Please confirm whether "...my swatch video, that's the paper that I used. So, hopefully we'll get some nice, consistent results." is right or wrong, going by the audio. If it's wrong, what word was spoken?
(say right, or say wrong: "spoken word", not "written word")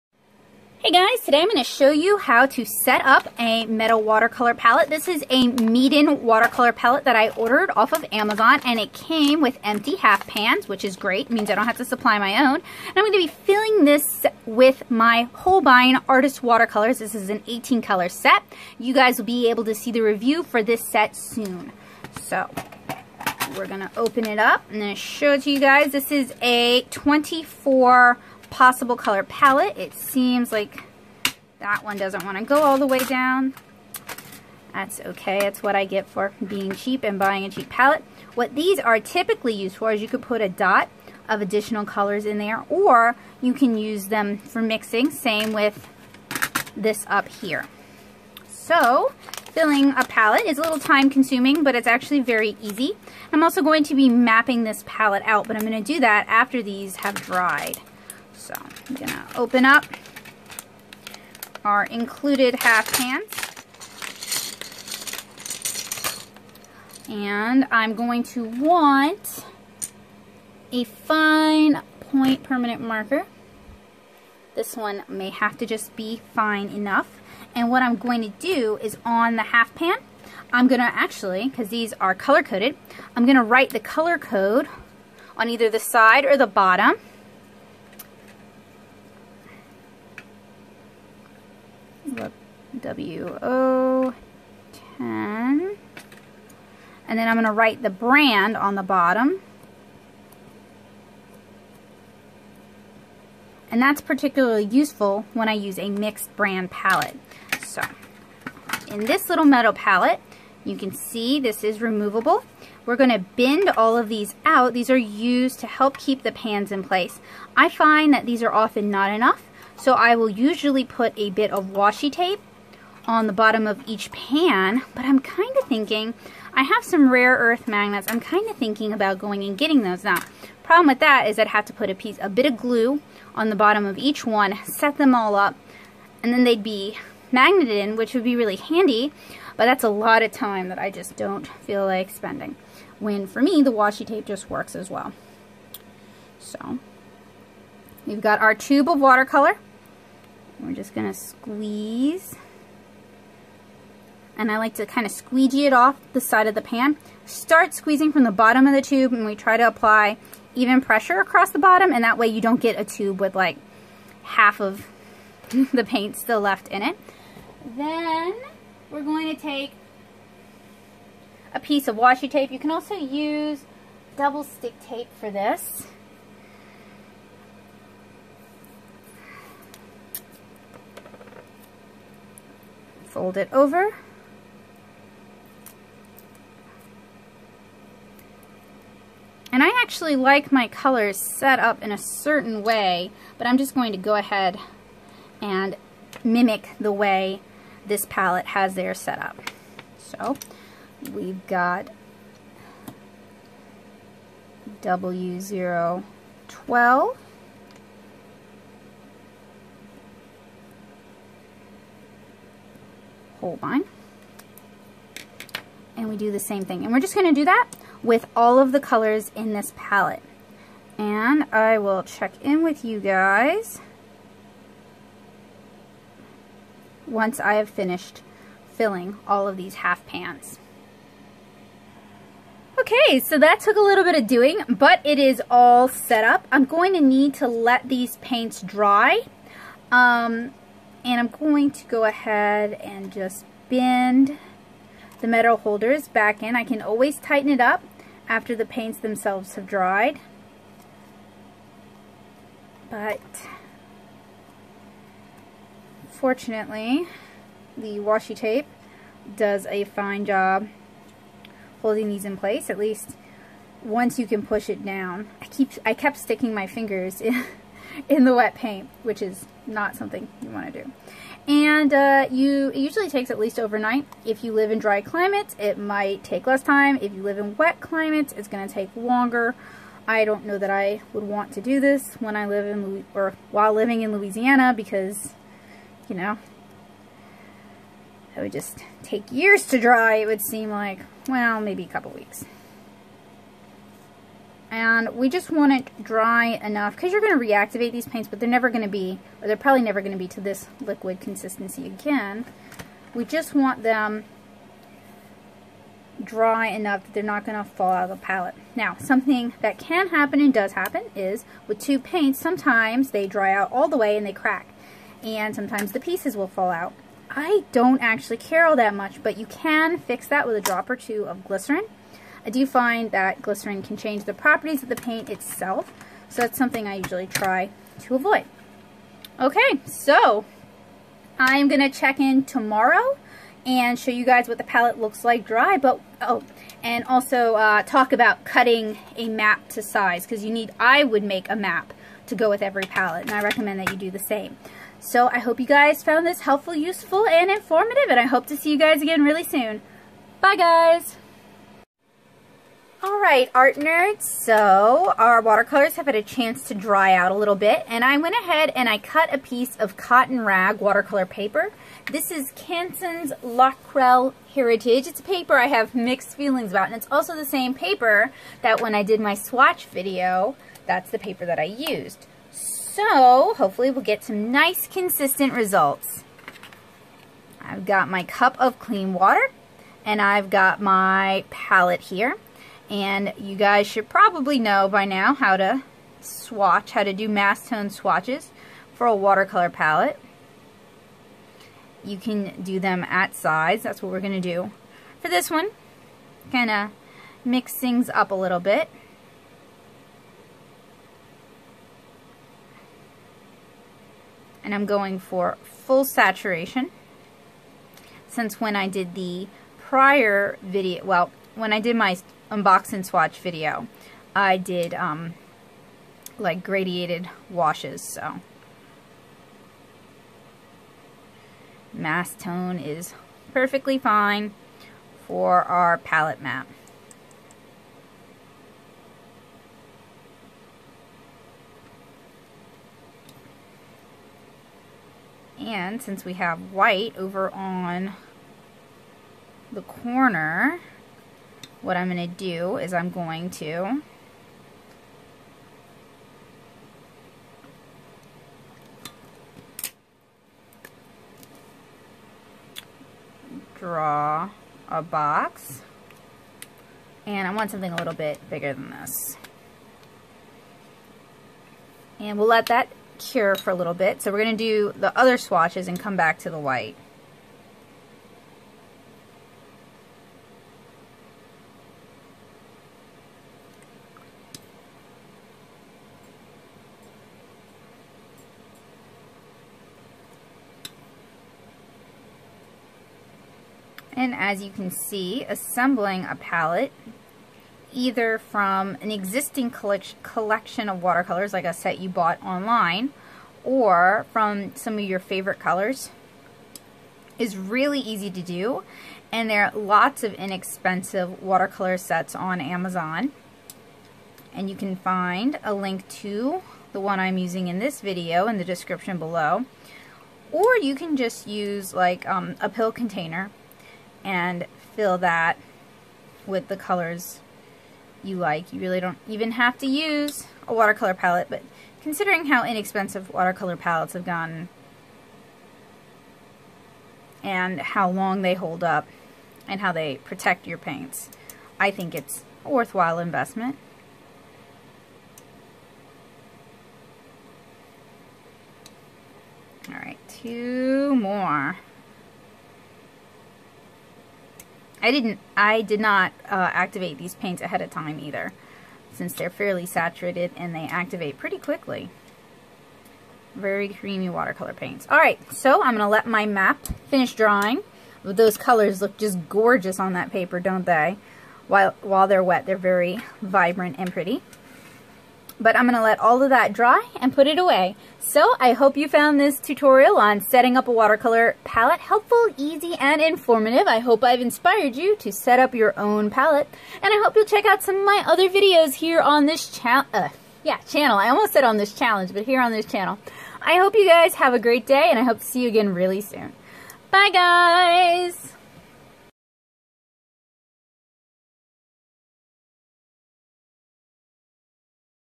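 right.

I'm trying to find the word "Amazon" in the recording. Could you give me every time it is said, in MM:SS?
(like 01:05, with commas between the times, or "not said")
00:08, 08:22.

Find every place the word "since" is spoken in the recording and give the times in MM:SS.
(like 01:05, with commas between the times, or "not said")
06:48, 07:16, 09:09.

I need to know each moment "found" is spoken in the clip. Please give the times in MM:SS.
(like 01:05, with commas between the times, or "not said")
05:46, 09:29.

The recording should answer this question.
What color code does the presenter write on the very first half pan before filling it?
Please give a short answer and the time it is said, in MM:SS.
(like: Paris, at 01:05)
WO10, at 01:32.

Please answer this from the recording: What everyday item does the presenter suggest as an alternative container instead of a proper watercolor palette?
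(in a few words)
a pill container.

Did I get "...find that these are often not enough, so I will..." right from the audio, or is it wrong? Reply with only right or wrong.
right.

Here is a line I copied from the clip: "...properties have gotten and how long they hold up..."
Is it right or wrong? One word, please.
wrong.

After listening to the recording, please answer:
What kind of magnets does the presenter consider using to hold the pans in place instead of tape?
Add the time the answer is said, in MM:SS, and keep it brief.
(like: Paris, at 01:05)
rare earth magnets, at 02:07.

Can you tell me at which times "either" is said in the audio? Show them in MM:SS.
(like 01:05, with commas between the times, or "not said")
01:25, 08:07, 09:08.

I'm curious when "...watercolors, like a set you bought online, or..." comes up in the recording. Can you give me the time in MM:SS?
08:11.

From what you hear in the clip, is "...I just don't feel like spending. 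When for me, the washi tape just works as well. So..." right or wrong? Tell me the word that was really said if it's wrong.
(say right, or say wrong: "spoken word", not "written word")
right.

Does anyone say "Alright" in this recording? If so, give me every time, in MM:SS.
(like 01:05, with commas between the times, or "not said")
05:53, 08:59.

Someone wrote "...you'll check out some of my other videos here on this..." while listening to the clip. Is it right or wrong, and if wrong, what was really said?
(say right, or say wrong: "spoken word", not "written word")
right.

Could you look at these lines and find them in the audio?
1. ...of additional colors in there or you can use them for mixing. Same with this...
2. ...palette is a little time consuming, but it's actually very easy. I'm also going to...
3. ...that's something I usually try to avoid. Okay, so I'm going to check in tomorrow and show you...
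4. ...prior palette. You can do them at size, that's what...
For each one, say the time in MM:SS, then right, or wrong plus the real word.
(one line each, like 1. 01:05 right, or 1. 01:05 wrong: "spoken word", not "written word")
1. 00:41 right
2. 00:50 right
3. 05:26 right
4. 06:29 wrong: "watercolor", not "prior".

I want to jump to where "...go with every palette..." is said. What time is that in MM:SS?
05:42.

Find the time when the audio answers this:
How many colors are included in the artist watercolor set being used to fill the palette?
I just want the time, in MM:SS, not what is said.
00:17.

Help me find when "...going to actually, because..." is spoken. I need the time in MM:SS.
01:20.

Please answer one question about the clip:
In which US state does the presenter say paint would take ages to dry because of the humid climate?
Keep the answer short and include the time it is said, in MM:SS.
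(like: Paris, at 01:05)
Louisiana, at 04:44.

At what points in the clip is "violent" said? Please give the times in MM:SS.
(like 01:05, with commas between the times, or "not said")
not said.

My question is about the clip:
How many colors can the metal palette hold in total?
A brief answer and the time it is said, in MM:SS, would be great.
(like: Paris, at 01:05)
24, at 00:26.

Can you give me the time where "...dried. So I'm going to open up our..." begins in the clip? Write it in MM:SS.
00:57.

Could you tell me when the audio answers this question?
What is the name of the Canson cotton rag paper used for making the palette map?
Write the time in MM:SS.
06:03.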